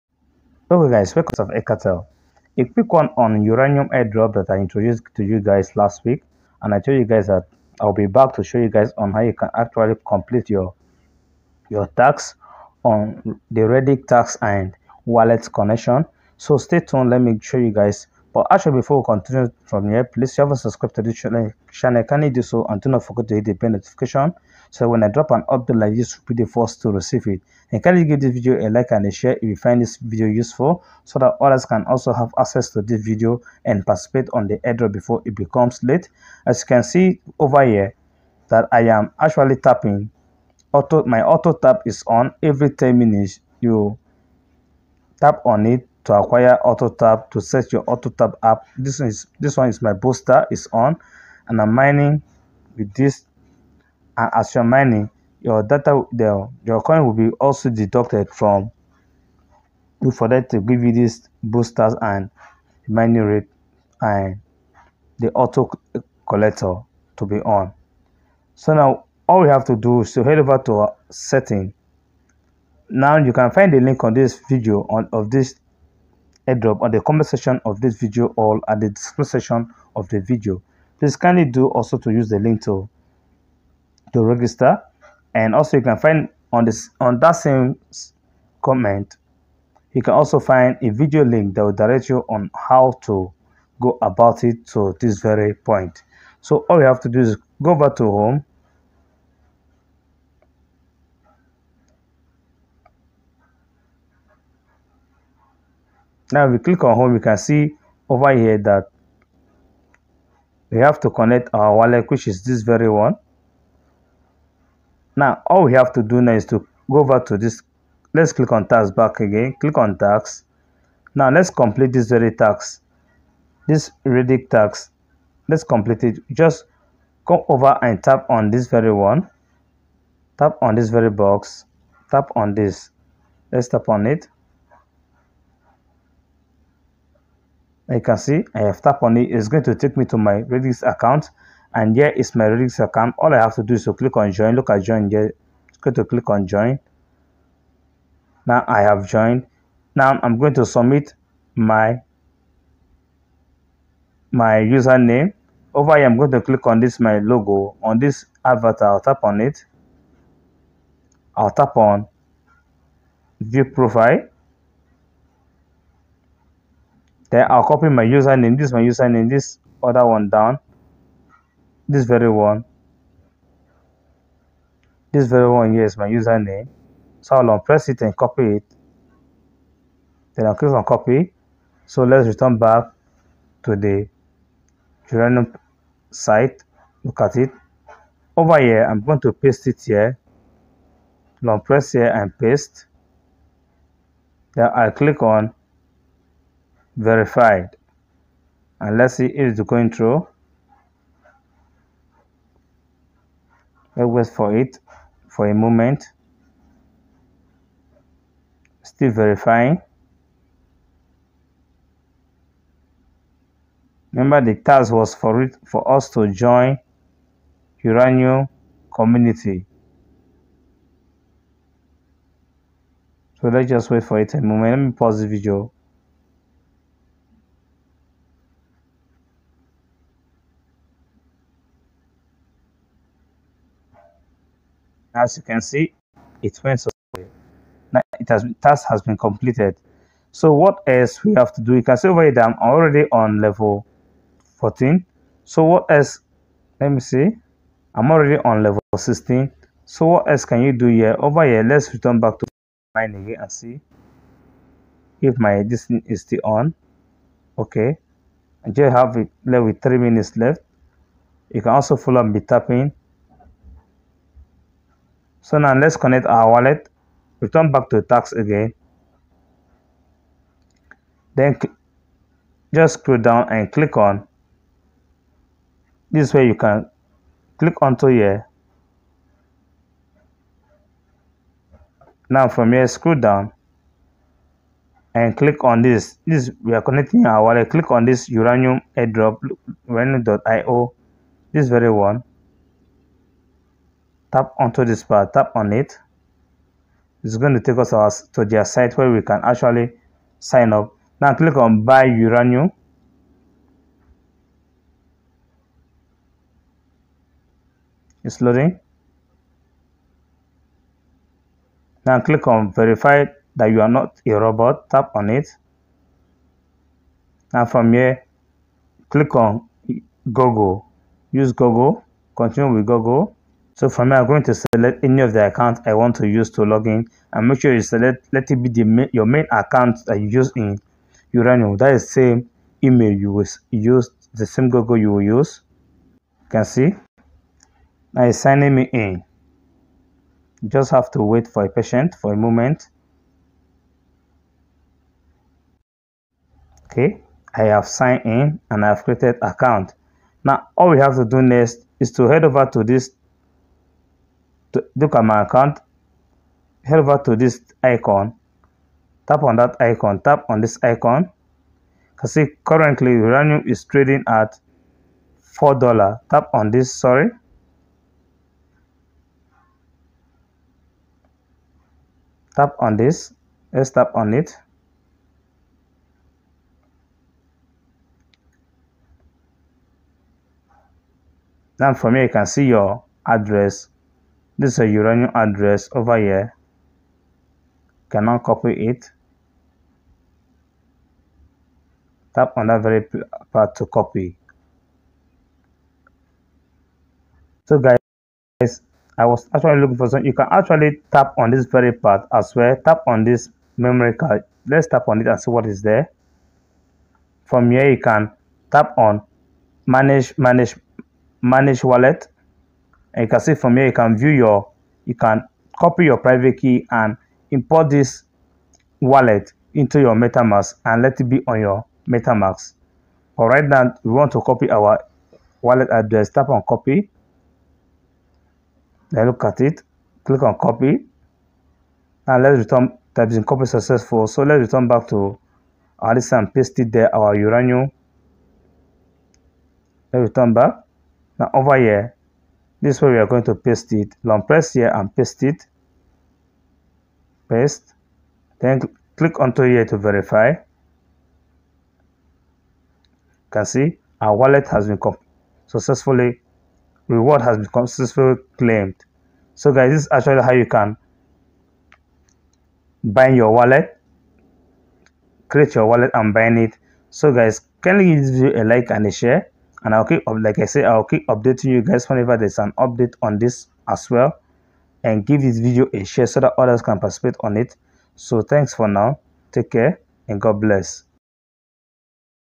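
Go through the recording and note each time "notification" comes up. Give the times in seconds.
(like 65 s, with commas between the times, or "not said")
23 s.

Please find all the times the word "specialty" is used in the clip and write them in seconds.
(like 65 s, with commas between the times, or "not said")
not said.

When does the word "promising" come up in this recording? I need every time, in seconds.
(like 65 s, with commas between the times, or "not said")
not said.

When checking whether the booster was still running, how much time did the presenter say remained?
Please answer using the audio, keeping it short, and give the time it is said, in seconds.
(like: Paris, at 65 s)
Three minutes, at 259 s.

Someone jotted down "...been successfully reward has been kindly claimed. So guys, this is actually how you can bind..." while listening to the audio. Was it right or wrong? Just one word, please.
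wrong.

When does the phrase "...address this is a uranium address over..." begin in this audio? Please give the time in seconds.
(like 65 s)
383 s.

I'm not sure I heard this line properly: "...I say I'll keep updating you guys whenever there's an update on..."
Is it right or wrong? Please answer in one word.
right.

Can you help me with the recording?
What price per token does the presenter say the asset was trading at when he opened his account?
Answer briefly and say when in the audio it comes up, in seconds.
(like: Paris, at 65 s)
$4, at 365 s.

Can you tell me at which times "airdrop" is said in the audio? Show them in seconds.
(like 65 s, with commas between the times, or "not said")
3 s, 34 s, 76 s, 288 s.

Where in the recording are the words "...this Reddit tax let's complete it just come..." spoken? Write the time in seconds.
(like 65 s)
123 s.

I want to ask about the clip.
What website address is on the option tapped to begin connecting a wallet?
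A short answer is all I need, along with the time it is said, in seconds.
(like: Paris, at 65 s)
uranium.io, at 289 s.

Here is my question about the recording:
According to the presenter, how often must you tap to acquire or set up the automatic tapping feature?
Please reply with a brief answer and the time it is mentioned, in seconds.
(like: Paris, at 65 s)
Every 10 minutes, at 42 s.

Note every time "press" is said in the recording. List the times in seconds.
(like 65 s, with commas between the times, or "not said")
177 s, 191 s, 444 s.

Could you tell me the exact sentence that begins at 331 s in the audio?
That is same email you will use, the same Google you will use.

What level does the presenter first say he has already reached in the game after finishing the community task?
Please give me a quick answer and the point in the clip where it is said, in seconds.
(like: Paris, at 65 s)
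Level 14, at 243 s.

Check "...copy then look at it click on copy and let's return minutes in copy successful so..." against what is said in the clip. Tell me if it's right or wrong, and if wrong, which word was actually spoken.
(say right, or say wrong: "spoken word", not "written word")
wrong: "types", not "minutes".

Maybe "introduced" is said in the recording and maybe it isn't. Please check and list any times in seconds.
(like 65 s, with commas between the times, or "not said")
4 s.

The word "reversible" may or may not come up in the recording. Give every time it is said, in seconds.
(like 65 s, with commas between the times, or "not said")
not said.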